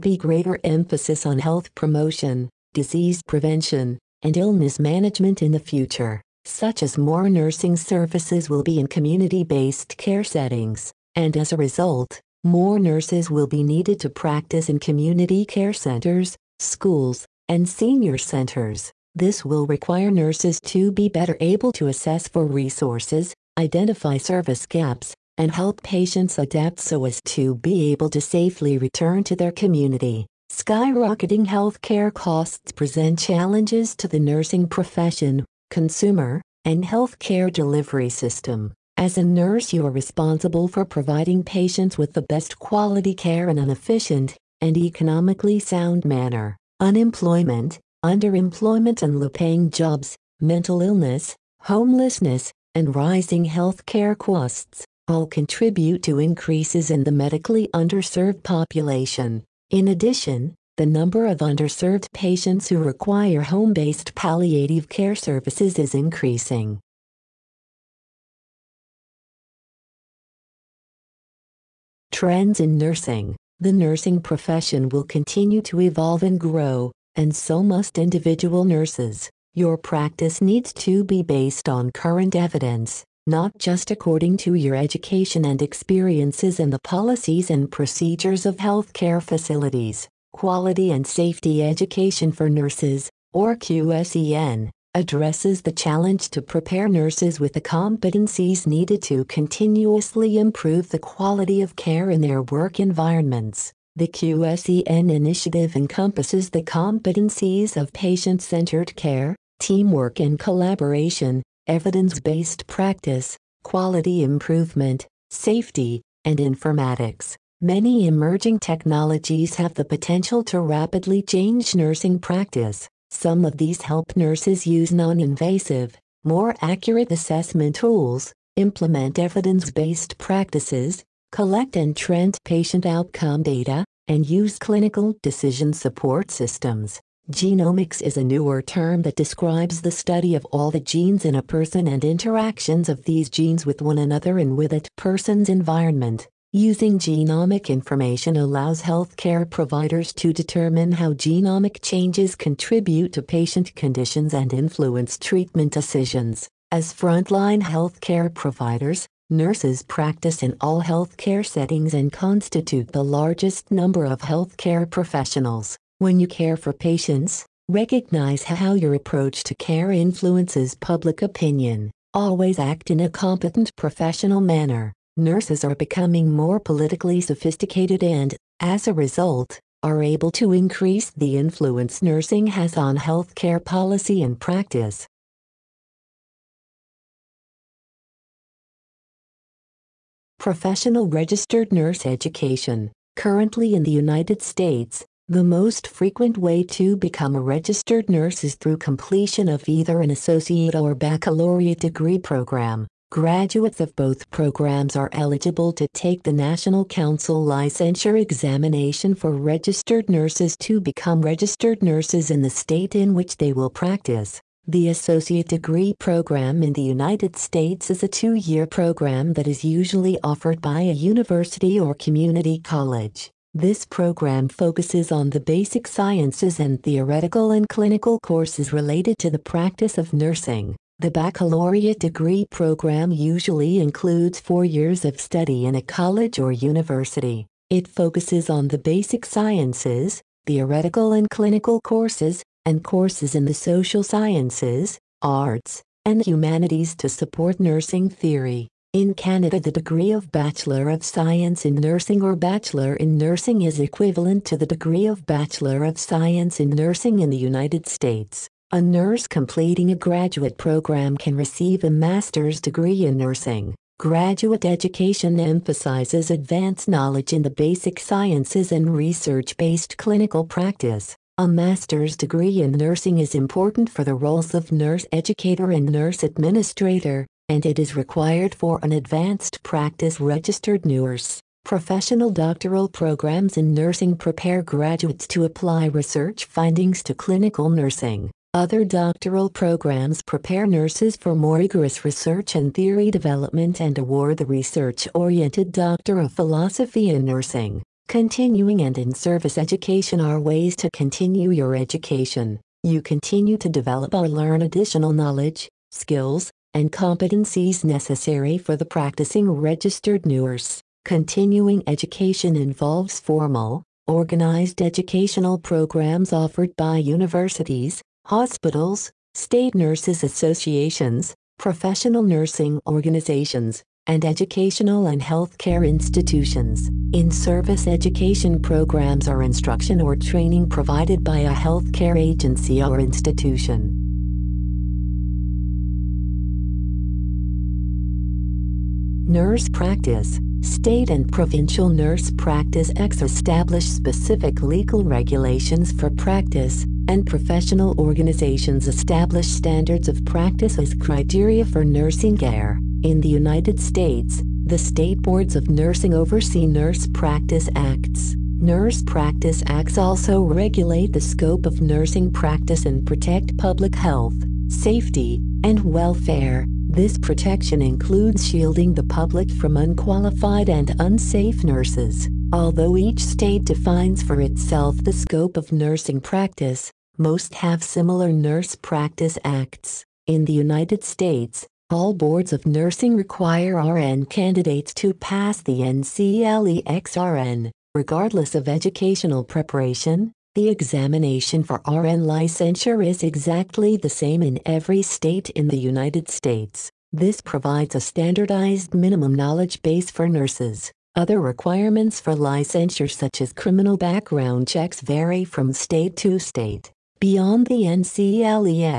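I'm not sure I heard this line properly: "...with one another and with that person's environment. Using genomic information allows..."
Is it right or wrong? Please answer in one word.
right.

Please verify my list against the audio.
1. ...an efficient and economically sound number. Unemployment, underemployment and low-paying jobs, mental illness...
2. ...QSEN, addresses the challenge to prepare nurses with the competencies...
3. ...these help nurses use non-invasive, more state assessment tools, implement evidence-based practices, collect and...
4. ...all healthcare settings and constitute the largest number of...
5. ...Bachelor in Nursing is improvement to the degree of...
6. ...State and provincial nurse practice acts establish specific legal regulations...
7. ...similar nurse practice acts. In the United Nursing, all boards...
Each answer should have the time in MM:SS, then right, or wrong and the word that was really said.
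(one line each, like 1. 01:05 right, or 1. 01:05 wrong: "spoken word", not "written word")
1. 00:43 wrong: "manner", not "number"
2. 01:33 right
3. 02:03 wrong: "accurate", not "state"
4. 02:40 right
5. 04:12 wrong: "equivalent", not "improvement"
6. 05:40 right
7. 06:17 wrong: "States", not "Nursing".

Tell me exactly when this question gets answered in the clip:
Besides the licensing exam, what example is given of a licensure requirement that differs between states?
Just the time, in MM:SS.
06:43.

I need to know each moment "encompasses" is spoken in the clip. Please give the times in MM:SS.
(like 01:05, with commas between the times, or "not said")
01:45.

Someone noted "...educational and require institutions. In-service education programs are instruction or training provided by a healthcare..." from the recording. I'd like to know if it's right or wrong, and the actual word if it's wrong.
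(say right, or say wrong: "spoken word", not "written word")
wrong: "healthcare", not "require".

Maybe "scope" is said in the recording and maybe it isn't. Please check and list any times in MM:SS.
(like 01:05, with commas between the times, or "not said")
06:01, 06:15.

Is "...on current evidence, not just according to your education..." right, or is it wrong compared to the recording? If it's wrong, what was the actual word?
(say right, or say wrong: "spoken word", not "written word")
right.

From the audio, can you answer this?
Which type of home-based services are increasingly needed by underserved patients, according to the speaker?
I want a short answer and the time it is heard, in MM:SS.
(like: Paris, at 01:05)
Palliative care, at 01:04.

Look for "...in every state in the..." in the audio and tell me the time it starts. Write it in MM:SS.
06:34.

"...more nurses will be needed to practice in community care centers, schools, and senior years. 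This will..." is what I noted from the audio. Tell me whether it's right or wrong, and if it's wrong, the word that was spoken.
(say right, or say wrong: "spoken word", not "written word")
wrong: "centers", not "years".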